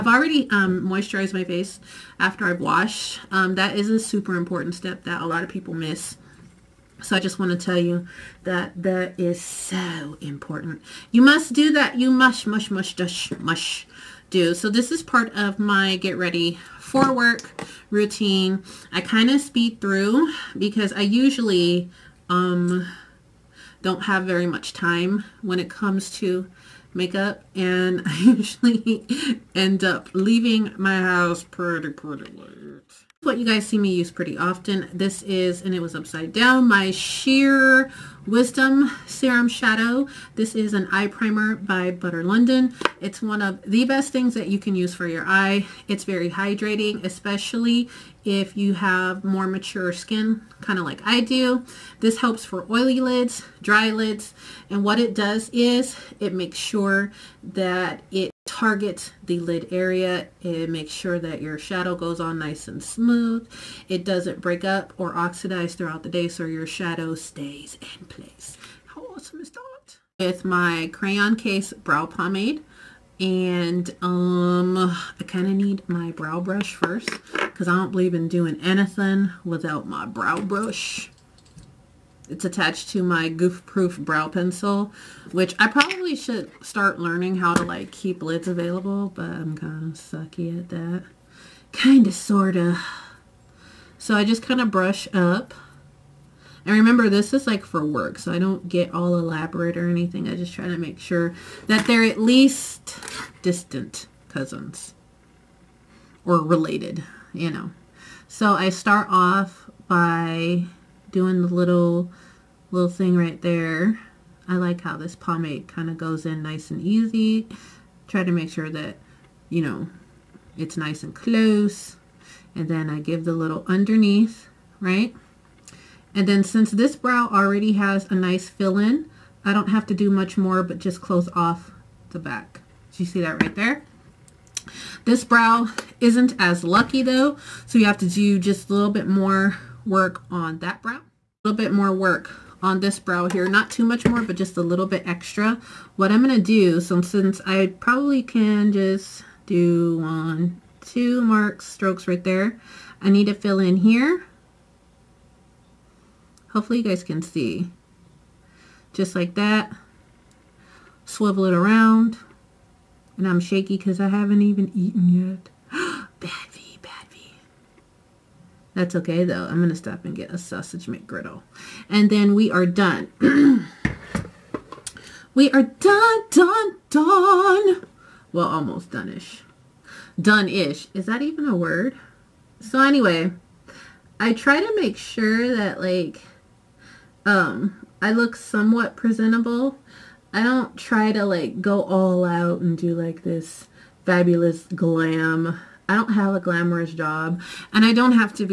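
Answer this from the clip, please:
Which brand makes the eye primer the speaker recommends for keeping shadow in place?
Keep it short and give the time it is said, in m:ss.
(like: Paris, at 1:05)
Butter London, at 0:41.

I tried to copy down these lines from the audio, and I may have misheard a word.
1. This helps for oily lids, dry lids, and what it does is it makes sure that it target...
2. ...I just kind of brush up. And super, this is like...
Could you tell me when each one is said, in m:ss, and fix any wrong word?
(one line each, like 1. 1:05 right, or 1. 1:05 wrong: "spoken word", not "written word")
1. 0:52 right
2. 1:34 wrong: "remember", not "super".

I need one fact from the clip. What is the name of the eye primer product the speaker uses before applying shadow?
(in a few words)
Sheer Wisdom Serum Shadow.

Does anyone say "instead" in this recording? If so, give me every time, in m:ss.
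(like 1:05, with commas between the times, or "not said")
not said.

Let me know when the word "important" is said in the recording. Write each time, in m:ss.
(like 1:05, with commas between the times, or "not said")
0:04, 0:10.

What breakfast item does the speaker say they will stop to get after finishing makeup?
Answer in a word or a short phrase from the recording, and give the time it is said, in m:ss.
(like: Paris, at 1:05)
sausage McGriddle, at 2:50.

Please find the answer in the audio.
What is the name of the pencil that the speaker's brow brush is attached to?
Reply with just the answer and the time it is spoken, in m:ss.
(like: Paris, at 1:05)
Goof Proof, at 1:23.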